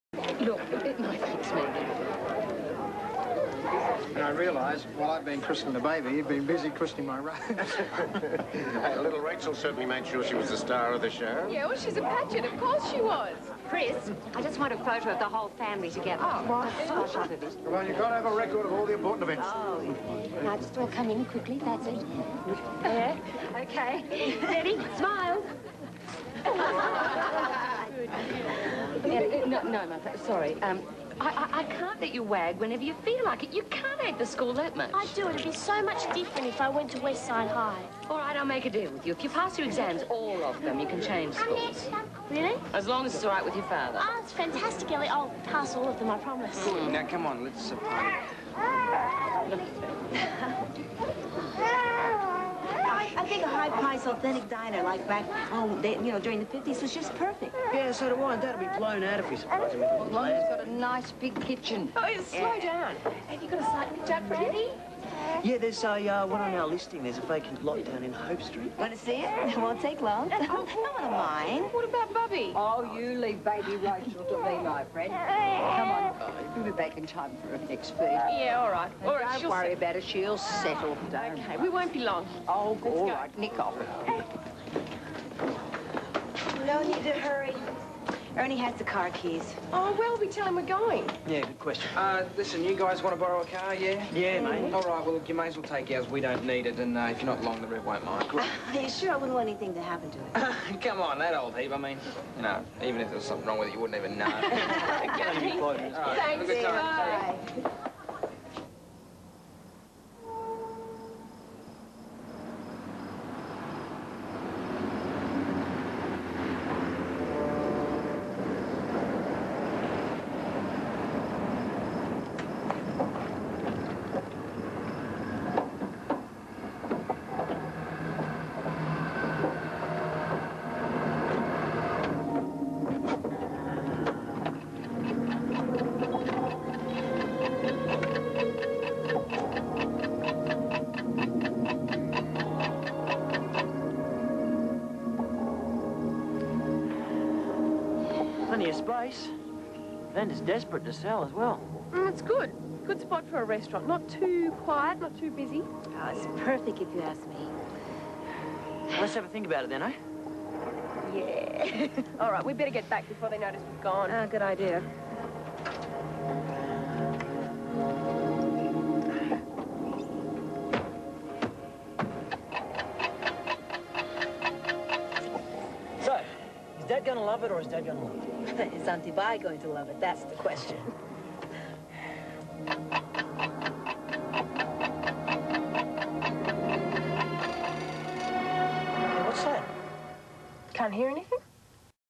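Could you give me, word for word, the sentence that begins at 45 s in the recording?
I'll pass all of them, I promise.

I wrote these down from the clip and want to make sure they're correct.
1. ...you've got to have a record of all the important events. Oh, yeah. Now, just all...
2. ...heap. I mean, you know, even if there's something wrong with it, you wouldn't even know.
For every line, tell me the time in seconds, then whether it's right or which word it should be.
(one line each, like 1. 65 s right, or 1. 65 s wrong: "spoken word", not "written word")
1. 17 s right
2. 101 s right.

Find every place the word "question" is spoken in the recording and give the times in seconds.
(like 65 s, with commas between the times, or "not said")
91 s, 180 s.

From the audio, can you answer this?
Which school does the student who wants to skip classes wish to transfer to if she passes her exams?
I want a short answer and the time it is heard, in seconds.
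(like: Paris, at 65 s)
Westside High, at 36 s.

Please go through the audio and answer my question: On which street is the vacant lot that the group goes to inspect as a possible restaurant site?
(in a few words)
Hope Street.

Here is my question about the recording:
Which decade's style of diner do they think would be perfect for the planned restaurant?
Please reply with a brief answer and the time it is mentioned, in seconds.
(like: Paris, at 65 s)
the 50s, at 56 s.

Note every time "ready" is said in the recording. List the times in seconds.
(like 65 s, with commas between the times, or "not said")
24 s, 64 s.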